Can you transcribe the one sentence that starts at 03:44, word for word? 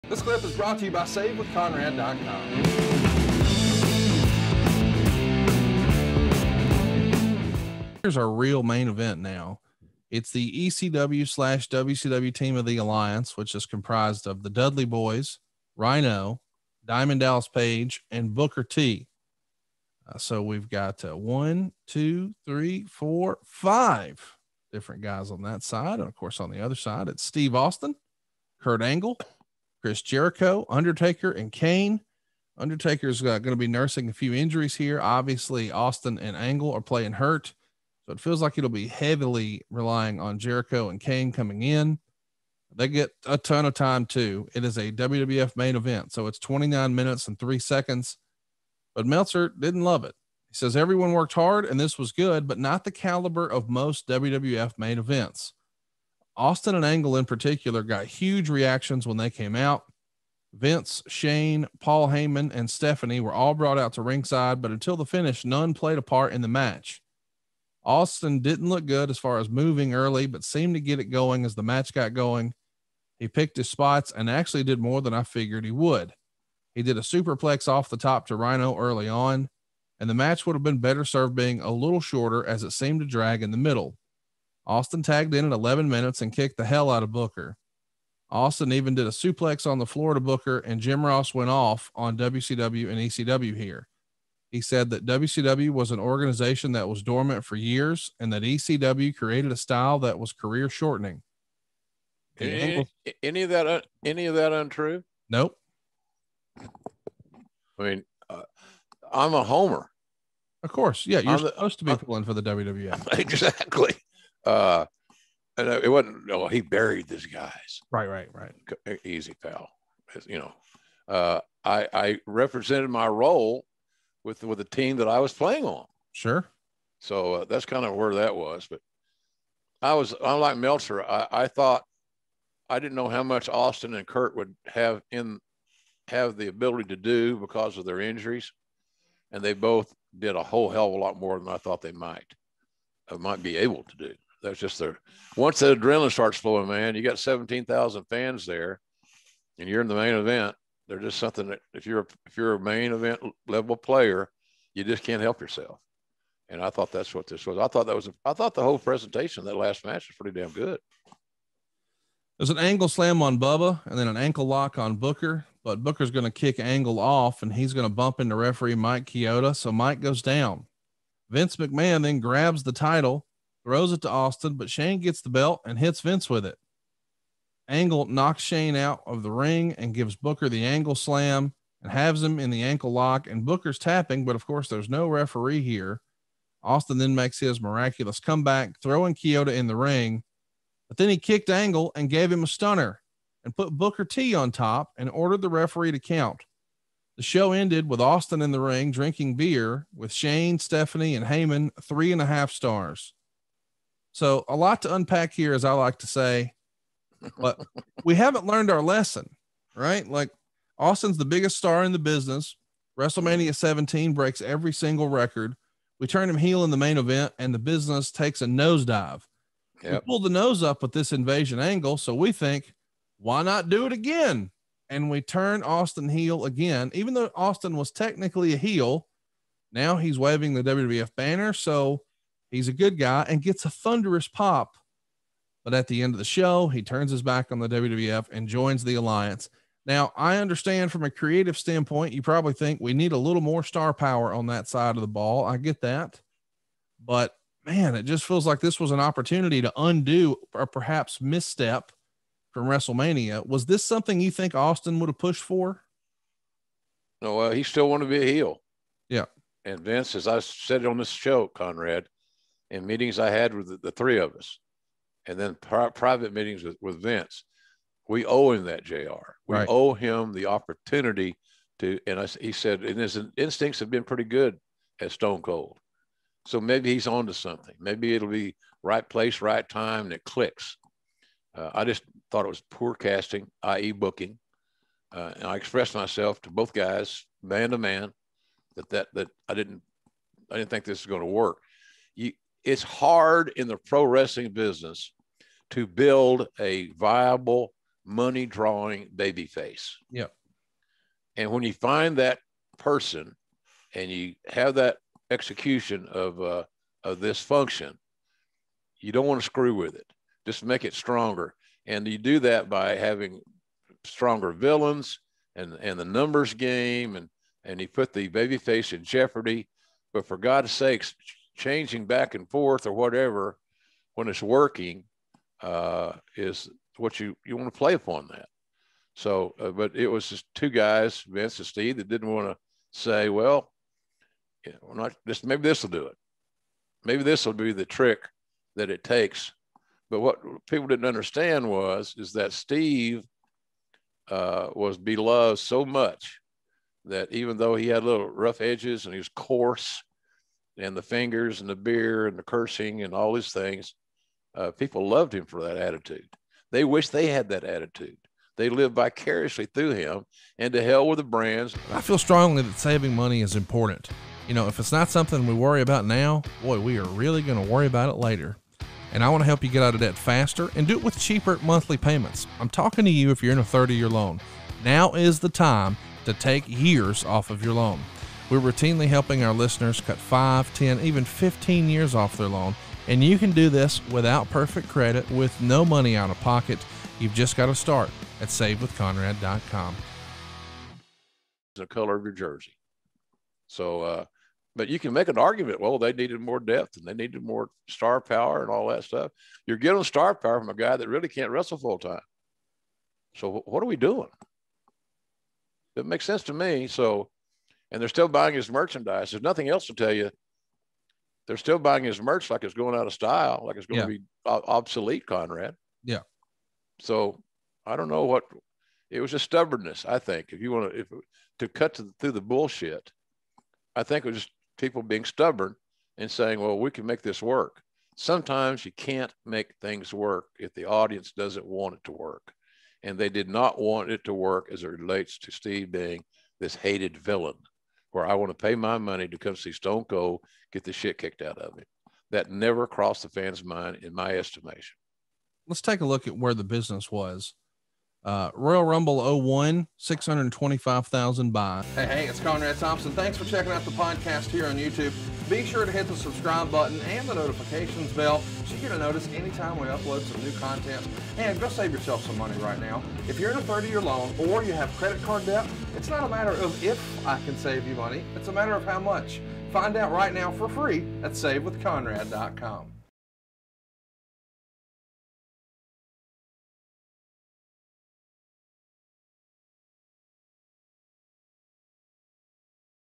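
And we turn Austin heel again, even though Austin was technically a heel.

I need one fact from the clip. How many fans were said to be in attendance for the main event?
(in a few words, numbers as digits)
17,000.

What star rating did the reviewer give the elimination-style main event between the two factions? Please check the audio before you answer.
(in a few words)
3.5 stars.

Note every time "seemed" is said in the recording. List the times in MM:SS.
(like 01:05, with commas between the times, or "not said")
01:10, 01:22.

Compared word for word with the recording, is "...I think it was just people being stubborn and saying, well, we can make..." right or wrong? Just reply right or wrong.
right.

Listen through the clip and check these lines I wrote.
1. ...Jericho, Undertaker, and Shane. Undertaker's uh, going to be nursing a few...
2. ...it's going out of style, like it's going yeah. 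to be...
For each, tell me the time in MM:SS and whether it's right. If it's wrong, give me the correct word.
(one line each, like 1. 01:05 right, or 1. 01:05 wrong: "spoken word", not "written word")
1. 00:30 wrong: "Kane", not "Shane"
2. 06:52 right.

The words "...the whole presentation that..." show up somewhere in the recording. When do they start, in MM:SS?
02:38.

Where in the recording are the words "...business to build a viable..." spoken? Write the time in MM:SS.
04:54.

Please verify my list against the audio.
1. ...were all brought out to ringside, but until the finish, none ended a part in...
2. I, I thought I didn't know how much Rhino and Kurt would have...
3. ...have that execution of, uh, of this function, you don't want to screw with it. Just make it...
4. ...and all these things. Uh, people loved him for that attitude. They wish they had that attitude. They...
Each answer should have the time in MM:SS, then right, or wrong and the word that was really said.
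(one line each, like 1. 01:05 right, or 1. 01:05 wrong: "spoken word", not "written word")
1. 01:03 wrong: "played", not "ended"
2. 02:11 wrong: "Austin", not "Rhino"
3. 05:04 right
4. 05:53 right.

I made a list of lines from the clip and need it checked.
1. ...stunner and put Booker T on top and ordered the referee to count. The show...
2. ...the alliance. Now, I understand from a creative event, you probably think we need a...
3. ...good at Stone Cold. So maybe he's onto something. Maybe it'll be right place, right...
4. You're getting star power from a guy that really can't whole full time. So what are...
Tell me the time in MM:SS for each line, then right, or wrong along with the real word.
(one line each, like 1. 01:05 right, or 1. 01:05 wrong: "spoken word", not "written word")
1. 03:12 right
2. 03:58 wrong: "standpoint", not "event"
3. 04:34 right
4. 06:39 wrong: "wrestle", not "whole".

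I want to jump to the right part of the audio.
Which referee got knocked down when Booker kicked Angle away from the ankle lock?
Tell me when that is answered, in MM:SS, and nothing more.
02:48.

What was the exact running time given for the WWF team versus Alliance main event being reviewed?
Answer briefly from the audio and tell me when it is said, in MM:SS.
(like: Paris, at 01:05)
29 minutes and 3 seconds, at 00:46.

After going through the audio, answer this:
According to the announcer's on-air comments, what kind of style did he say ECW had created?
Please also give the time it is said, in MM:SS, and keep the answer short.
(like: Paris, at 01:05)
career shortening, at 01:40.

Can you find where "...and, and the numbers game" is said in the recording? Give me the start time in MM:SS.
05:15.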